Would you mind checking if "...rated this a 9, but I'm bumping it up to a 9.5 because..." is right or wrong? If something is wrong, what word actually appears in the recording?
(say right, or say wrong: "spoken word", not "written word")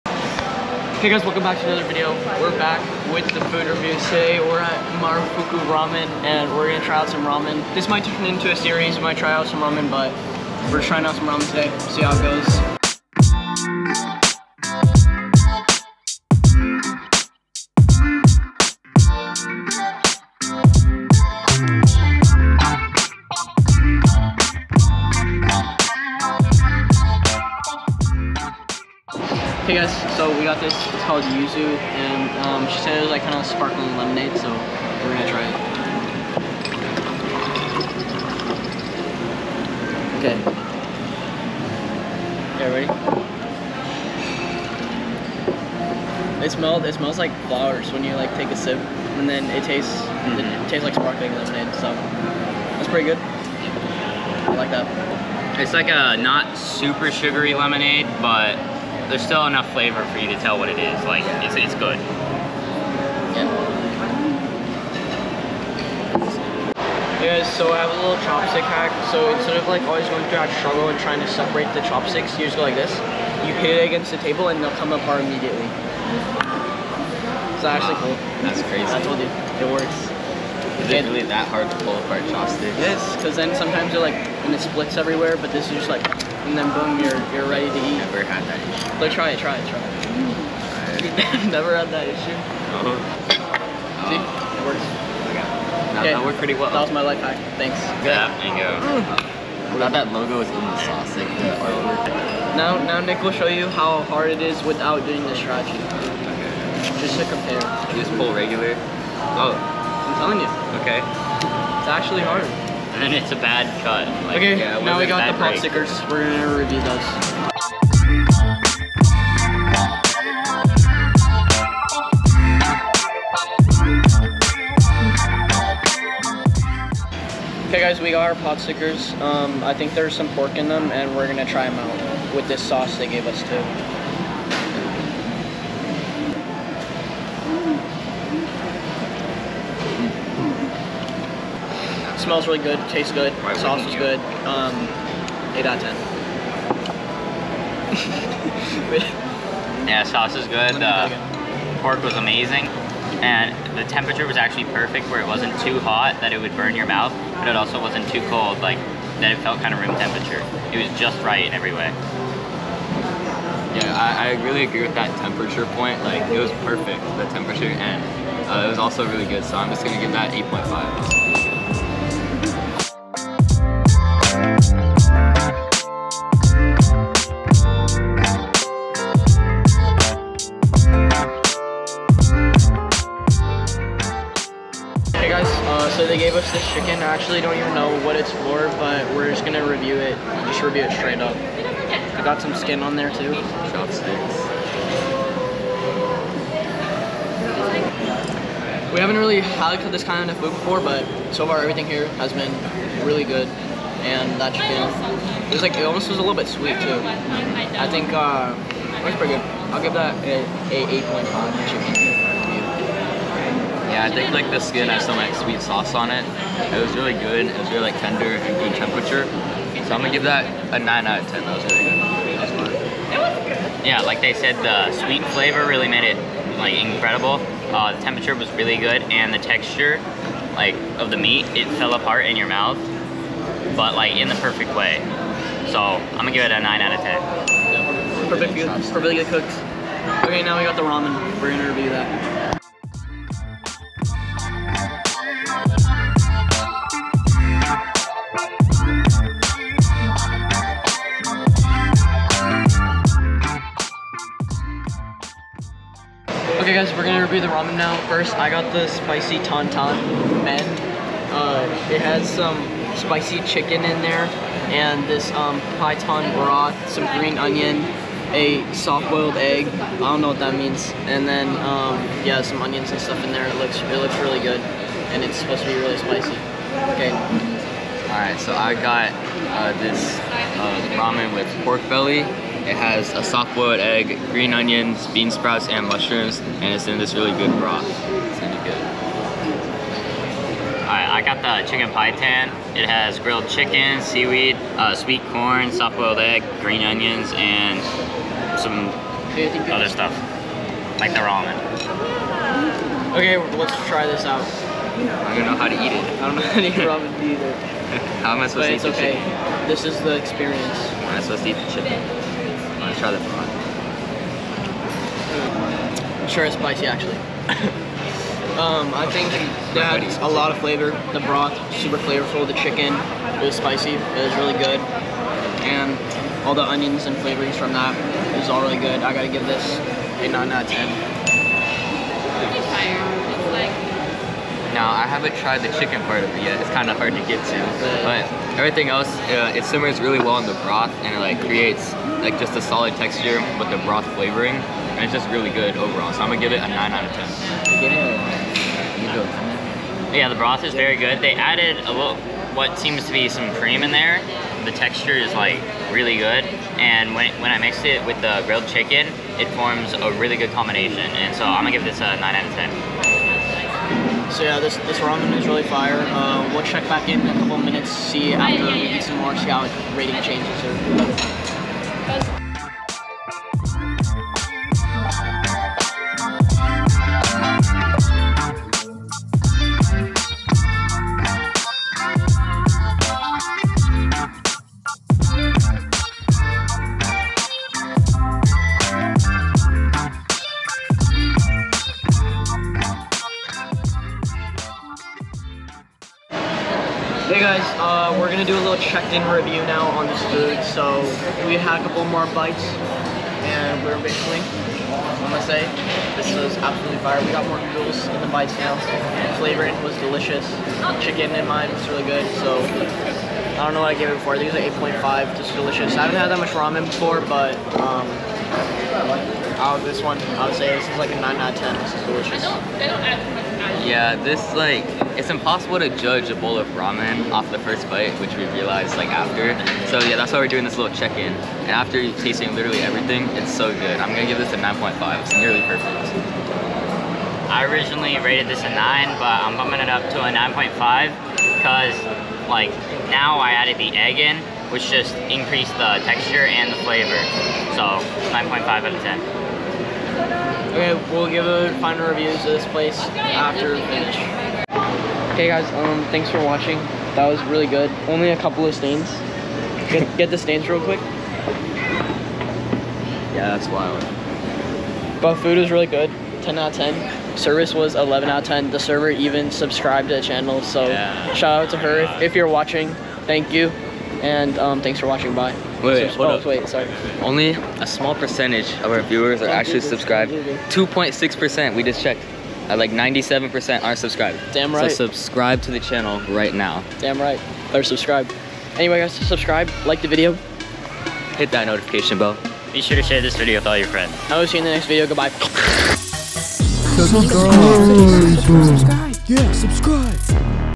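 right.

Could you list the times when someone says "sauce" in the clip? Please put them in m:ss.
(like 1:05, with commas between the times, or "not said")
1:40, 2:12, 2:23, 2:30, 3:35.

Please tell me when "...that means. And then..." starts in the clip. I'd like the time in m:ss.
4:30.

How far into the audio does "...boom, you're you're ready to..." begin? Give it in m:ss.
1:26.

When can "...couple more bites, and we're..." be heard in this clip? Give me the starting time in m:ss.
6:41.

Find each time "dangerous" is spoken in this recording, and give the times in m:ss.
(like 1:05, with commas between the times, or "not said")
not said.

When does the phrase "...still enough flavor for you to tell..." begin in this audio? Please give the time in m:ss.
0:59.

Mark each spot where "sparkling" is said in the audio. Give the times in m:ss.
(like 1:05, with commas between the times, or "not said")
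0:33, 0:50.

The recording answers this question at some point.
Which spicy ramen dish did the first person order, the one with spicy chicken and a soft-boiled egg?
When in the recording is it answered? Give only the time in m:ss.
4:18.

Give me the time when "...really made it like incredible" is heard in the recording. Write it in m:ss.
3:45.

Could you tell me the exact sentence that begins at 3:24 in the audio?
And that chicken, it was like, it almost was a little bit sweet too.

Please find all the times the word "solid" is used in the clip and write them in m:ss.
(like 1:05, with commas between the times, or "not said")
5:42.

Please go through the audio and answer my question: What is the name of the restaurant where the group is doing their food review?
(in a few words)
Marufuku Ramen.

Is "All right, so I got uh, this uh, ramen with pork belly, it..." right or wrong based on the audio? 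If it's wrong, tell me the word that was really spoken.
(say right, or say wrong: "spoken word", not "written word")
right.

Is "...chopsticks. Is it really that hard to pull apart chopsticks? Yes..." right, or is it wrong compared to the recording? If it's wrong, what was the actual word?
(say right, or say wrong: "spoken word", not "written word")
wrong: "works", not "chopsticks".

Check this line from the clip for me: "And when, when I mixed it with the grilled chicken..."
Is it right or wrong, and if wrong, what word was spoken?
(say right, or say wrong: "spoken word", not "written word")
right.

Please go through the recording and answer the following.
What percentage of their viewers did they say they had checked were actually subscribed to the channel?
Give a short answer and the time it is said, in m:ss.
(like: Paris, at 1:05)
2.6%, at 8:00.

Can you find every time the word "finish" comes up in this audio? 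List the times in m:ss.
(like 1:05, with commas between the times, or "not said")
7:33.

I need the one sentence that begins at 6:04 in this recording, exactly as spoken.
So yeah, this, this ramen is really fire.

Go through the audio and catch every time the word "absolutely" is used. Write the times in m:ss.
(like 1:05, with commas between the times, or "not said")
6:46.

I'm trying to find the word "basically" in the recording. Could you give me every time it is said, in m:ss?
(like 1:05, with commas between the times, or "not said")
6:44.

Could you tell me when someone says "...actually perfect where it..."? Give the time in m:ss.
2:34.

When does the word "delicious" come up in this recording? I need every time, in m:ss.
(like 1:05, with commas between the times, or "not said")
6:49, 6:55, 7:02.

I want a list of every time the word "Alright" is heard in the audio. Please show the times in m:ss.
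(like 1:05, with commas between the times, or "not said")
4:50.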